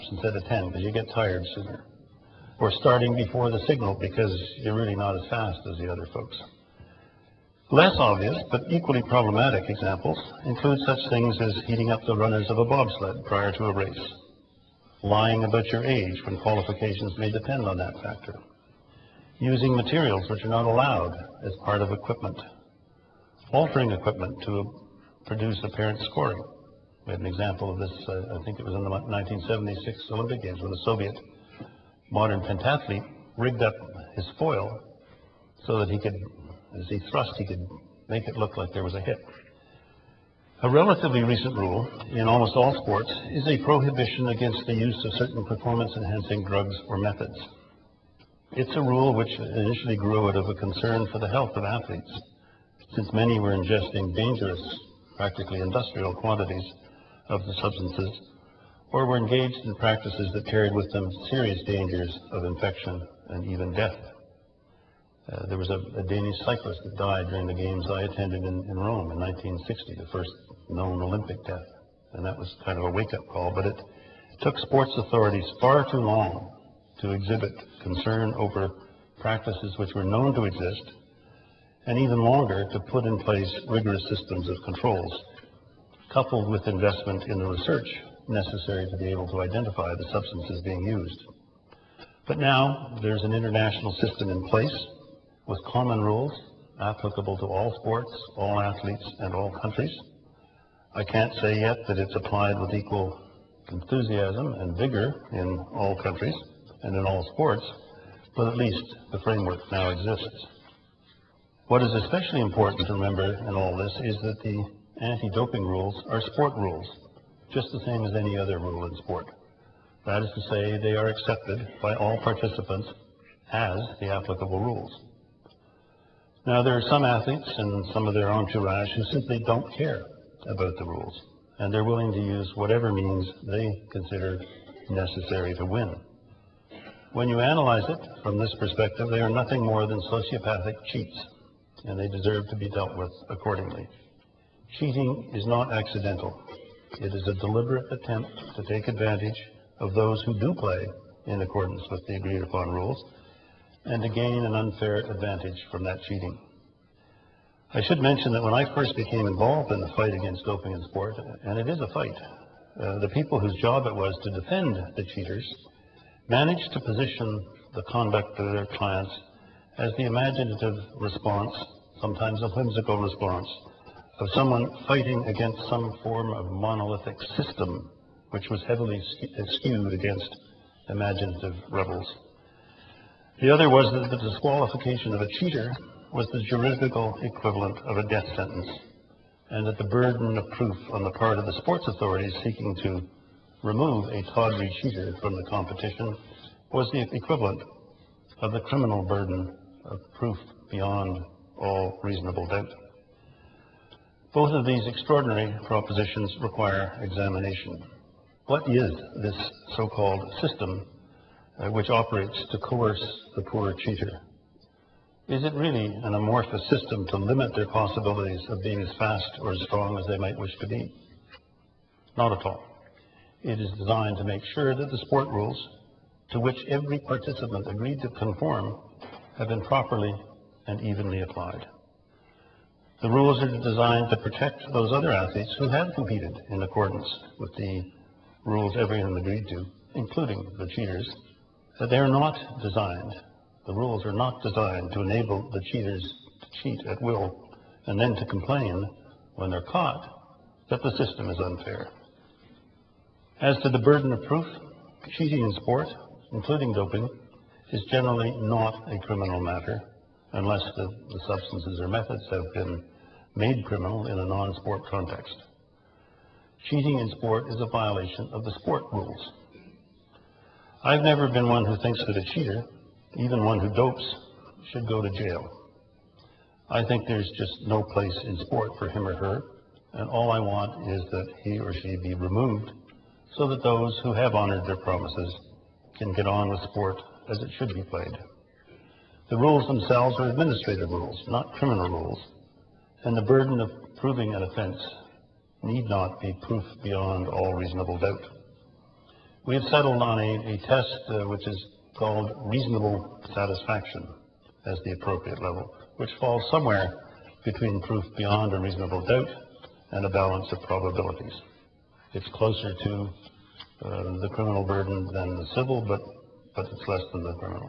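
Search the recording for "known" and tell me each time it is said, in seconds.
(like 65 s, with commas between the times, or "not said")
70 s, 80 s.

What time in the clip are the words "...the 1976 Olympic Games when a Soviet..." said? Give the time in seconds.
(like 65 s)
28 s.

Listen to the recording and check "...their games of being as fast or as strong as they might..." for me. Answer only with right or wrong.
wrong.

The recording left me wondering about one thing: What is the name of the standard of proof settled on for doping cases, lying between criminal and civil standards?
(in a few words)
reasonable satisfaction.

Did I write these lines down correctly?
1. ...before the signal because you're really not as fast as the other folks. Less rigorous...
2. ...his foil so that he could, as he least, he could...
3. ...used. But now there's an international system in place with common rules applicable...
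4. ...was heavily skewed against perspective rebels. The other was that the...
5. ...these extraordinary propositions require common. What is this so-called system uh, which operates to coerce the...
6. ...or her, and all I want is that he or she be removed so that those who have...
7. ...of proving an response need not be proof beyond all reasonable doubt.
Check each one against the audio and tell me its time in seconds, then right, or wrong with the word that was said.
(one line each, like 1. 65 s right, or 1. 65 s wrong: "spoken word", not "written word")
1. 3 s wrong: "obvious", not "rigorous"
2. 34 s wrong: "thrust", not "least"
3. 90 s right
4. 178 s wrong: "imaginative", not "perspective"
5. 204 s wrong: "examination", not "common"
6. 279 s right
7. 293 s wrong: "offense", not "response".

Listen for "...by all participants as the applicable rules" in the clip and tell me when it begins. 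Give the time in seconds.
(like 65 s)
121 s.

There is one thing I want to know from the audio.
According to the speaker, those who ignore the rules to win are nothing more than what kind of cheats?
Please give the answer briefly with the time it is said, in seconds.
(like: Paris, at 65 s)
sociopathic, at 140 s.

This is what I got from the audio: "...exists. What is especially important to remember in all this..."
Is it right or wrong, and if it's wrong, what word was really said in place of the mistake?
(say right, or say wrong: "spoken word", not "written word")
right.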